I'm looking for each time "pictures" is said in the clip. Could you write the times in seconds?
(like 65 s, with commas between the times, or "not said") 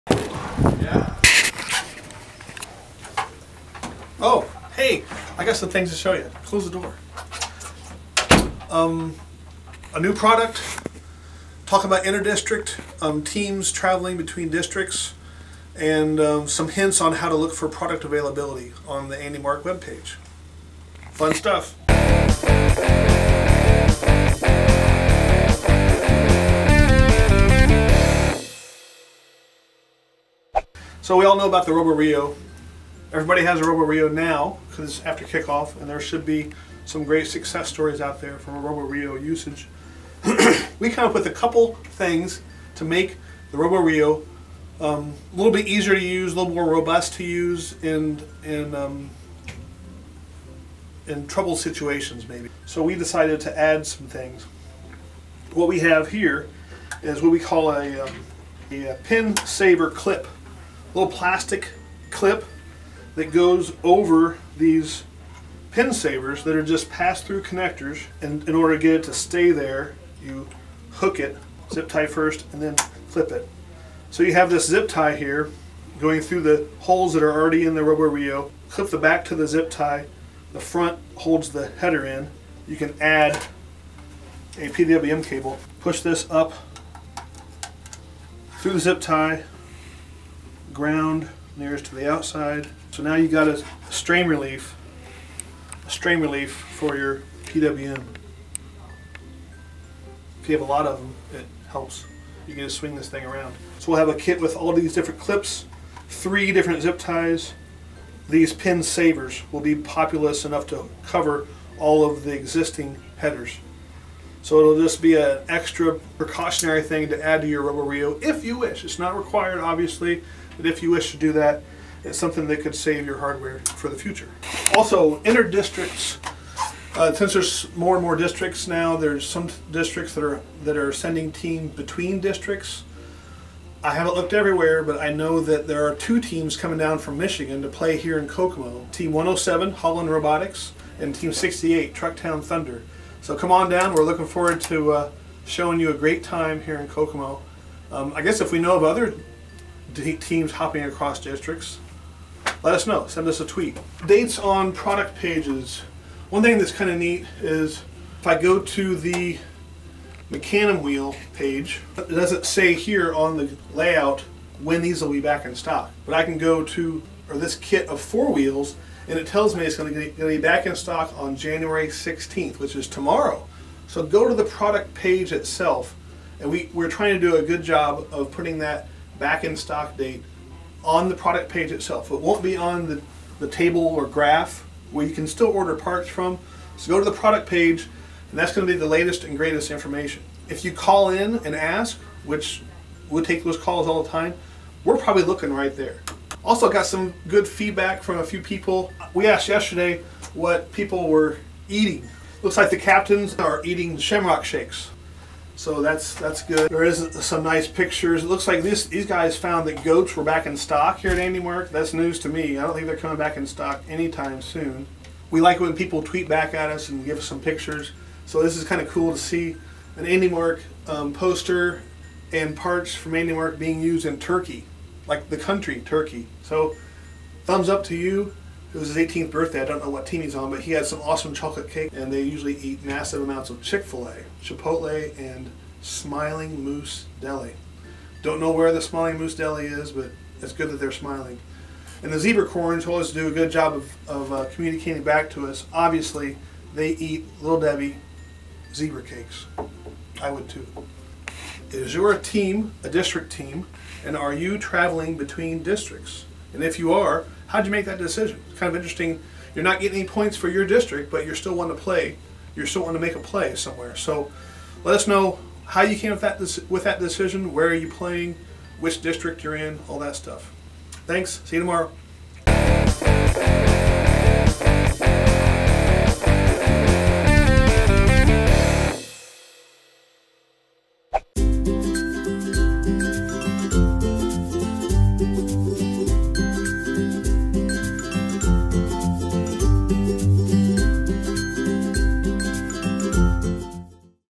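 207 s, 217 s.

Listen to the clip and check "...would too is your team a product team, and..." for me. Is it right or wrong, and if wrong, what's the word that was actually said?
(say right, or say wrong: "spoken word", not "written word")
wrong: "district", not "product".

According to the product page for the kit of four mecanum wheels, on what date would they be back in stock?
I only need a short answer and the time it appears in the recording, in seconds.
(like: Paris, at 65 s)
January 16th, at 171 s.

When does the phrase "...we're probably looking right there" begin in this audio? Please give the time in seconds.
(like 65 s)
194 s.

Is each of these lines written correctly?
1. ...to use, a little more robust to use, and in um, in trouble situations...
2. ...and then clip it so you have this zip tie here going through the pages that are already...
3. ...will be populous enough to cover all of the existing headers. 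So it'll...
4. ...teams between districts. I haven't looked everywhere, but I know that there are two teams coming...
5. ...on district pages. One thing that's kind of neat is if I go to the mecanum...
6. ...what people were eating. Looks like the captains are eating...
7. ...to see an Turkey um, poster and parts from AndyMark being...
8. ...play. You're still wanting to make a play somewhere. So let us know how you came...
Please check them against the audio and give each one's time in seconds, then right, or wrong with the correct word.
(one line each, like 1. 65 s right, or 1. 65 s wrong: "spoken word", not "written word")
1. 45 s right
2. 72 s wrong: "holes", not "pages"
3. 109 s right
4. 131 s right
5. 154 s wrong: "product", not "district"
6. 200 s right
7. 219 s wrong: "AndyMark", not "Turkey"
8. 261 s right.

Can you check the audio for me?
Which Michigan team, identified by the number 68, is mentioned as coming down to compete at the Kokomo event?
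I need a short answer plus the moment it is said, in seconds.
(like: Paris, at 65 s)
Trucktown Thunder, at 141 s.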